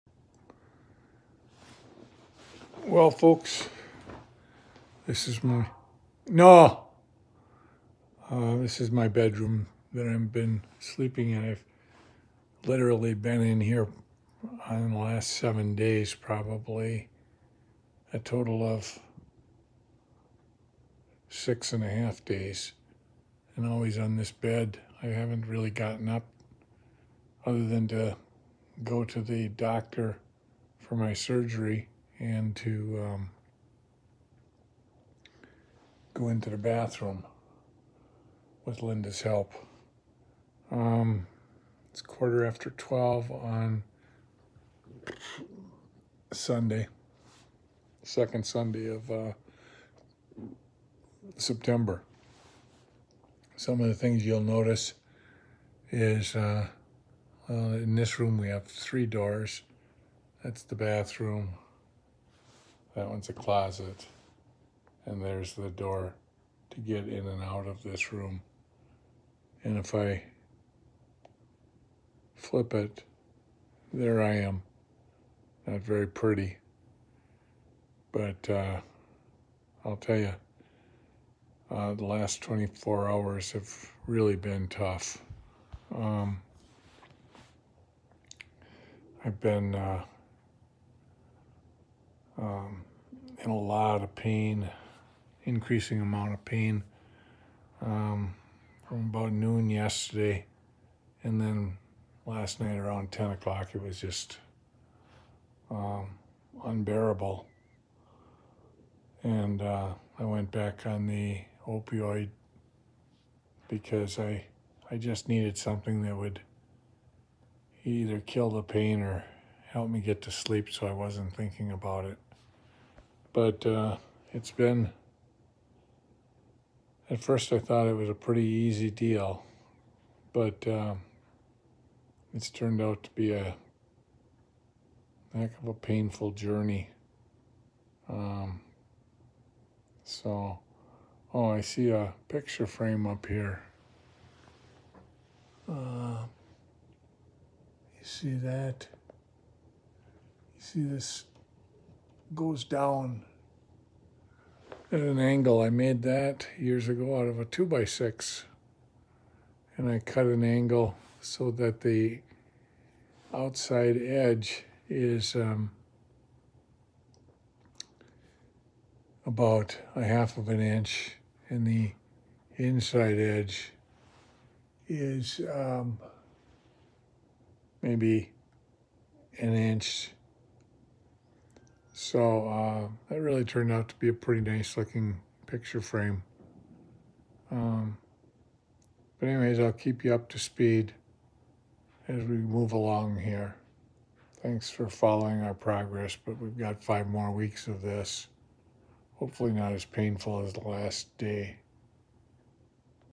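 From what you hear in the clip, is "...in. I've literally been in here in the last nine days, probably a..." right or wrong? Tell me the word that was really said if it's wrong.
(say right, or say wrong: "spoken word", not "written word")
wrong: "seven", not "nine".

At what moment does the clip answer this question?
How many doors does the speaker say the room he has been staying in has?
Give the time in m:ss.
0:58.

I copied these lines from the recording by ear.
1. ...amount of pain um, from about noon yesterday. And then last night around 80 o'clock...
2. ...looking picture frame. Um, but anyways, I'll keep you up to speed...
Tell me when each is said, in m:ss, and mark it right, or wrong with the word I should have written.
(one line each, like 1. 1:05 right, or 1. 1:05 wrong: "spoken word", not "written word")
1. 1:36 wrong: "10", not "80"
2. 3:04 right.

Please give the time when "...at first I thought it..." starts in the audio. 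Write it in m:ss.
2:07.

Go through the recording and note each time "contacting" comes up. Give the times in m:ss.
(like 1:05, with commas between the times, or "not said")
not said.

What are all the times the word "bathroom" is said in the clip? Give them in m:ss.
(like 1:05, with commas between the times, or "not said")
0:36, 1:00.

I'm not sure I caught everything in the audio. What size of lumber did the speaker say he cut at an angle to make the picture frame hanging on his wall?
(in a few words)
2x6.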